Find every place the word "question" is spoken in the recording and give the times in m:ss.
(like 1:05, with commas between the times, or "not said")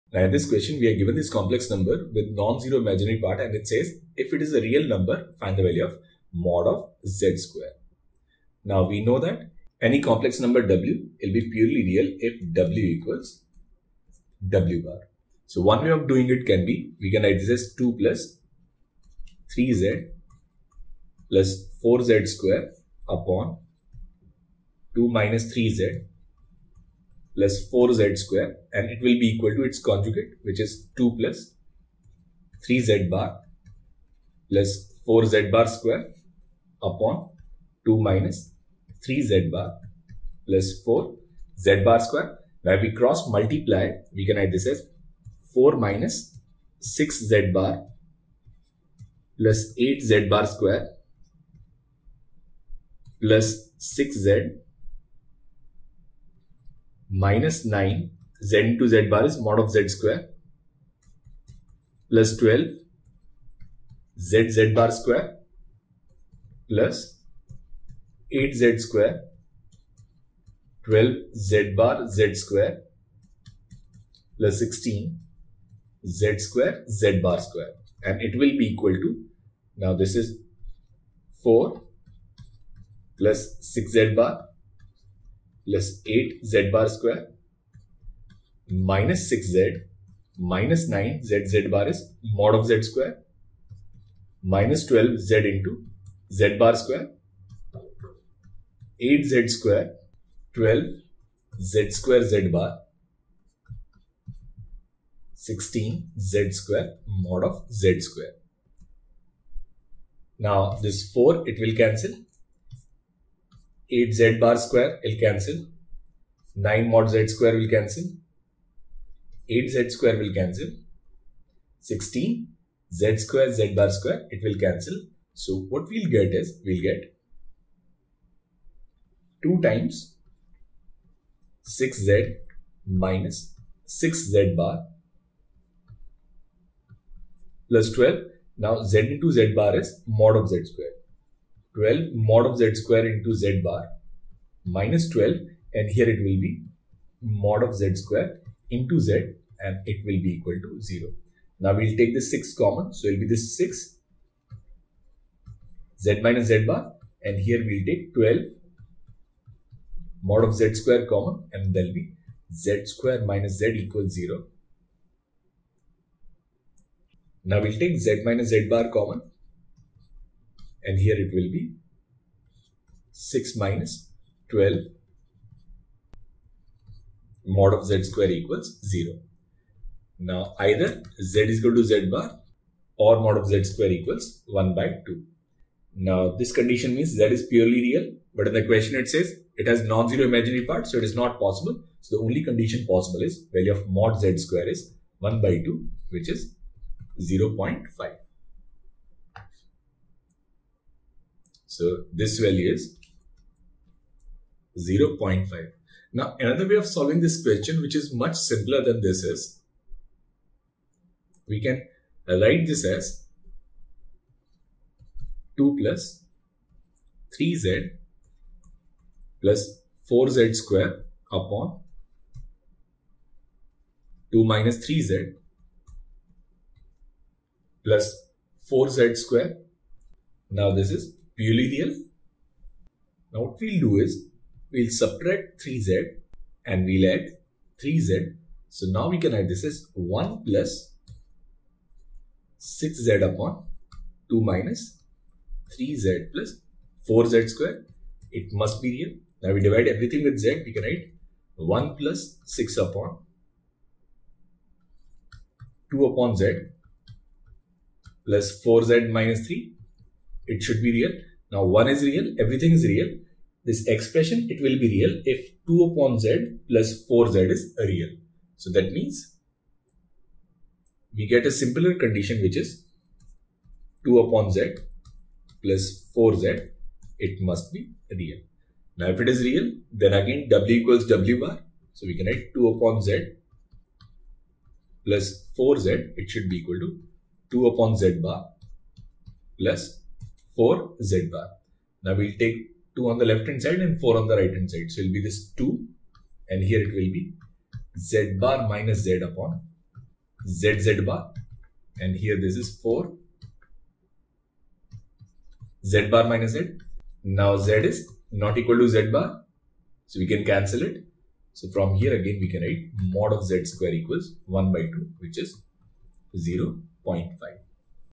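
0:00, 3:08, 3:27.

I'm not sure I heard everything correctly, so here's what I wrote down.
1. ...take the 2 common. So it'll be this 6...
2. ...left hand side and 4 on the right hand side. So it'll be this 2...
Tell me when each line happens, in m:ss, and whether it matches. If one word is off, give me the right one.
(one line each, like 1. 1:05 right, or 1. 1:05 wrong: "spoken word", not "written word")
1. 2:31 wrong: "6", not "2"
2. 4:53 right.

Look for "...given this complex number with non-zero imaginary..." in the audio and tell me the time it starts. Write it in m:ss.
0:00.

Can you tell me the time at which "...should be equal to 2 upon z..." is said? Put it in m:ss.
4:46.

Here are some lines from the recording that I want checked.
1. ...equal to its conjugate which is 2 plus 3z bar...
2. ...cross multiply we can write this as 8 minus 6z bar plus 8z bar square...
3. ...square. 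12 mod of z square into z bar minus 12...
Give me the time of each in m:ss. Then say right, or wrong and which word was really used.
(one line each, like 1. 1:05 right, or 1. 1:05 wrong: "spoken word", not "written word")
1. 0:29 right
2. 0:42 wrong: "4", not "8"
3. 2:20 right.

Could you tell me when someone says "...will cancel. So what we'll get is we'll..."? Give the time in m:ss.
2:04.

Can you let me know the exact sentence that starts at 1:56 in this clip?
9 mod z square will cancel.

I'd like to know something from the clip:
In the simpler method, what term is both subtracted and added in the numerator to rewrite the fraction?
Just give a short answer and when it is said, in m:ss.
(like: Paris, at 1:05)
3z, at 3:54.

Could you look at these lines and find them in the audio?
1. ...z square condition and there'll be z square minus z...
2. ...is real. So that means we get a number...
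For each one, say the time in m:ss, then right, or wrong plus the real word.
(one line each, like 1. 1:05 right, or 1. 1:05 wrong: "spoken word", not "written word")
1. 2:40 wrong: "common", not "condition"
2. 4:27 wrong: "simpler", not "number".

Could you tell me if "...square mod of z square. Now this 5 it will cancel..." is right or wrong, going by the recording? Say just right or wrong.
wrong.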